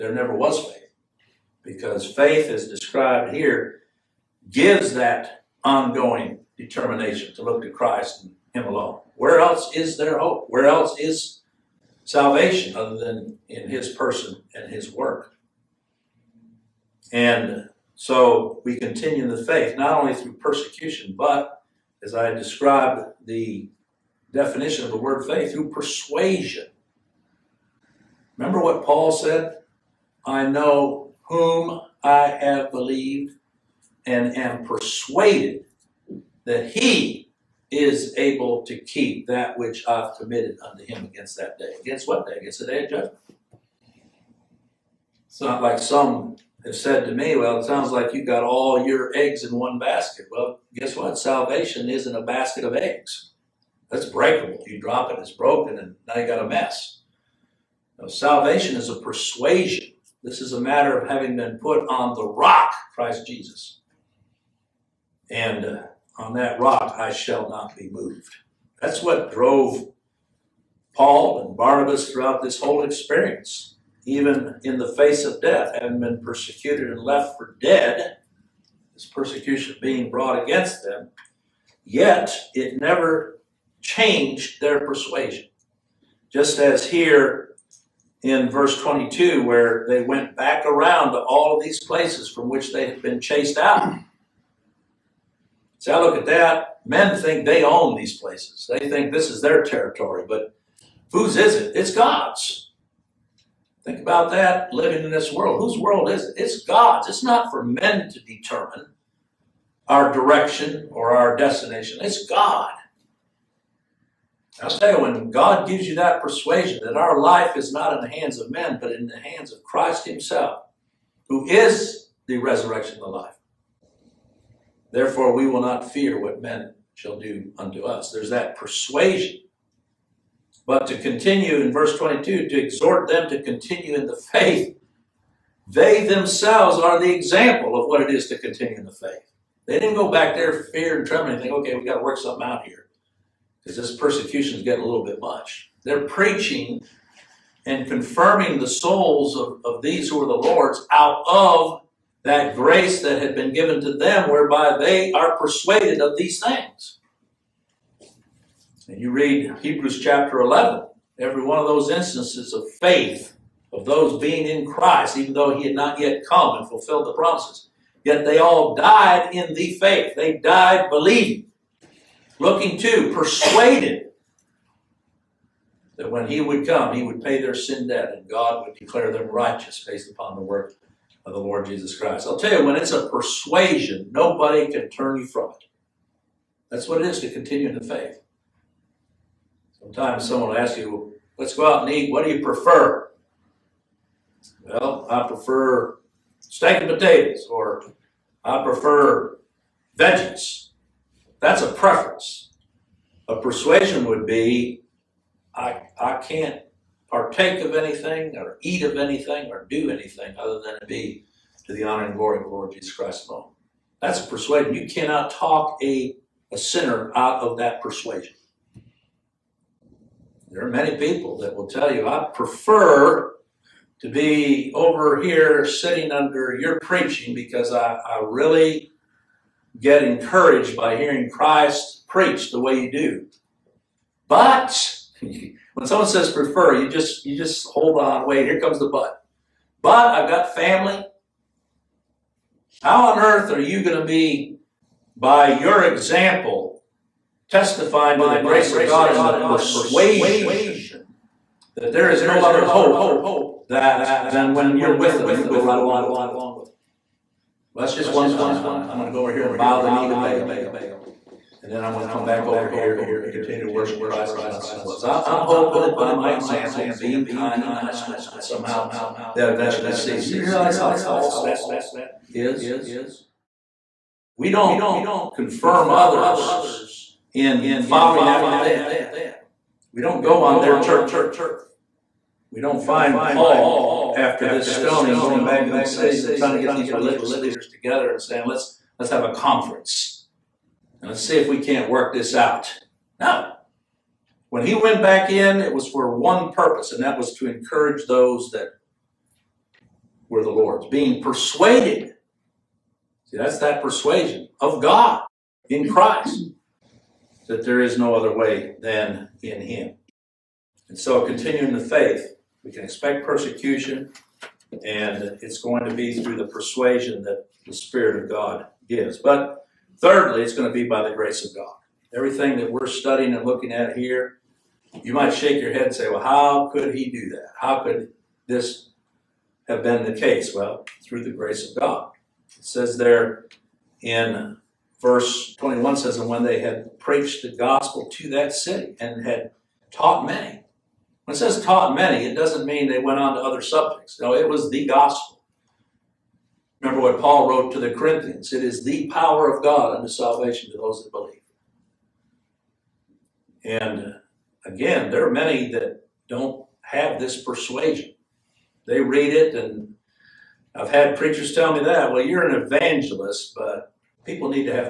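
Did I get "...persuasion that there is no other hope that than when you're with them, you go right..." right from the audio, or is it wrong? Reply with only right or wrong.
right.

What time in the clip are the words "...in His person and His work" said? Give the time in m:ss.
0:13.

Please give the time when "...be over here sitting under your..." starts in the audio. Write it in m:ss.
3:44.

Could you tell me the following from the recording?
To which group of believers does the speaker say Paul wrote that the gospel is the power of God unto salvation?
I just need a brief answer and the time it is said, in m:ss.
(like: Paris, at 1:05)
The Corinthians, at 5:47.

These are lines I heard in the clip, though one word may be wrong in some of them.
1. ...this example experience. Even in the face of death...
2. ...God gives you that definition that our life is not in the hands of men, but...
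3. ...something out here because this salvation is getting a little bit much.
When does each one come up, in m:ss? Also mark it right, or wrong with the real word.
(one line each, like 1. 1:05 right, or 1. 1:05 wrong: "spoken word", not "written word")
1. 1:12 wrong: "whole", not "example"
2. 1:55 wrong: "persuasion", not "definition"
3. 2:22 wrong: "persecution", not "salvation".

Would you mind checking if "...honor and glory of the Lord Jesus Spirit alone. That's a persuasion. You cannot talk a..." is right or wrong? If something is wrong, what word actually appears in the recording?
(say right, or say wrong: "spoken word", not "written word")
wrong: "Christ", not "Spirit".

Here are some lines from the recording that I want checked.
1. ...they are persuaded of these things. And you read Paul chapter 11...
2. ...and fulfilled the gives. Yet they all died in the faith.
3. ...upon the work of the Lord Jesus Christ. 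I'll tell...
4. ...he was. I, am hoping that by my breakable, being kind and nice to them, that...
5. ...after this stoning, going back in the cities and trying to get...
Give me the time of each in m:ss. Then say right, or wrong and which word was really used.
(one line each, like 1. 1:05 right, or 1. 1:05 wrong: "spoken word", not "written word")
1. 2:34 wrong: "Hebrews", not "Paul"
2. 2:46 wrong: "promises", not "gives"
3. 3:00 right
4. 4:24 wrong: "example", not "breakable"
5. 4:44 right.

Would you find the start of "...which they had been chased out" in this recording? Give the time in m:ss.
1:32.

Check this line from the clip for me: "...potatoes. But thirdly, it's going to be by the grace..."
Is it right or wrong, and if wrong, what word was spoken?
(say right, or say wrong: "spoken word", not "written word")
wrong: "gives", not "potatoes".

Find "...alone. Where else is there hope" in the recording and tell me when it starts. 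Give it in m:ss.
0:08.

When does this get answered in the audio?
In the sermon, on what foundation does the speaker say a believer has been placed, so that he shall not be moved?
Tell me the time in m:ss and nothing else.
1:02.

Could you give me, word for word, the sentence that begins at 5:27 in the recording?
How could this have been the case?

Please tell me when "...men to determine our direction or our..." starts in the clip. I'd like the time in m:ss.
1:47.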